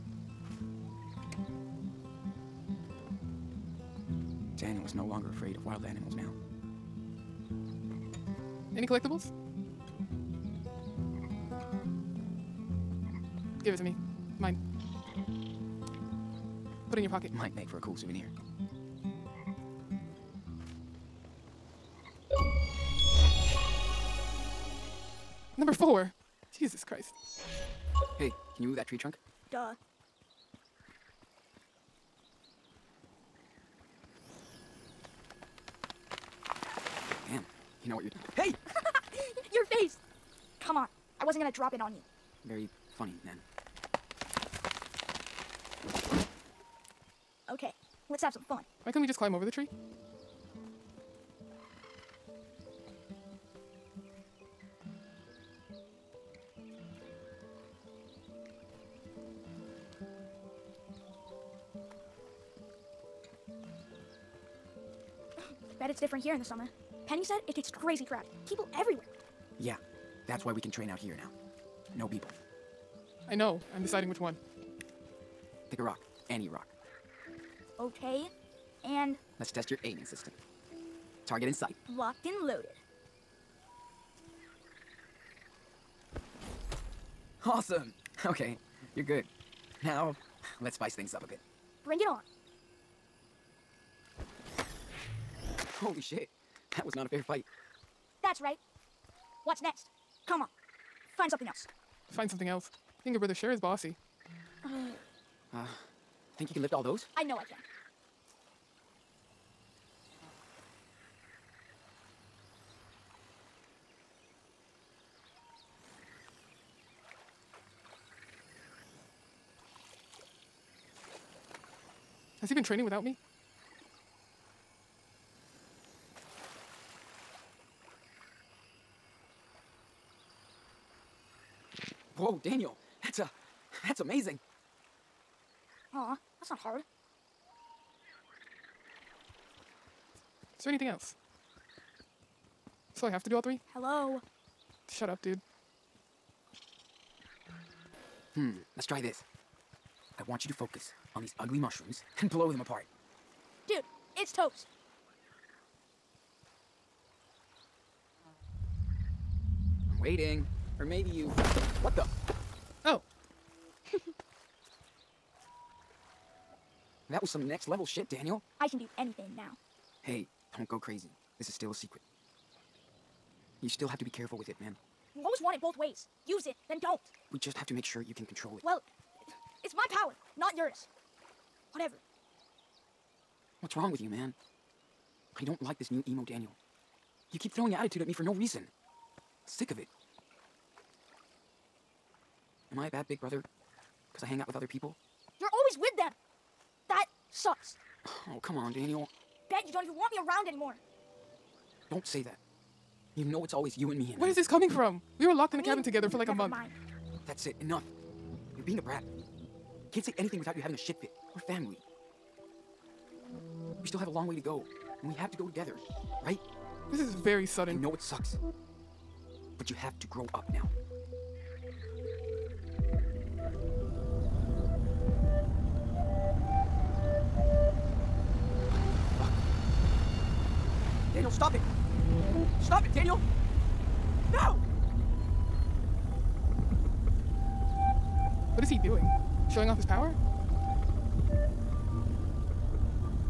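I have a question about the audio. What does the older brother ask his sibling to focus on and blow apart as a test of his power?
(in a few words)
ugly mushrooms.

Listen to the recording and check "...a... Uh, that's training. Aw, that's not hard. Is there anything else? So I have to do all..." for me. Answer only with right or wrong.
wrong.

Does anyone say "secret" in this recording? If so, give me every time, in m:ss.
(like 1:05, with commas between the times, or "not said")
2:51.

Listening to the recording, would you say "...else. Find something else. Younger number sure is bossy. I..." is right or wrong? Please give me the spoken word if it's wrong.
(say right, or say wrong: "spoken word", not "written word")
wrong: "brother", not "number".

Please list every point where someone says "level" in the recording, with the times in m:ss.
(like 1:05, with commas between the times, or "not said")
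2:47.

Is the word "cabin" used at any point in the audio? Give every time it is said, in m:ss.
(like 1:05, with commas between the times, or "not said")
3:25.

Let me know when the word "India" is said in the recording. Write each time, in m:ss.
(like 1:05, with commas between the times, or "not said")
not said.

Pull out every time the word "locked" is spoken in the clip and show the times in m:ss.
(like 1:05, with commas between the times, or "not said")
1:21, 3:25.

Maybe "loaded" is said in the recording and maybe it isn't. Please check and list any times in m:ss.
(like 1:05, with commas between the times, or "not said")
1:22.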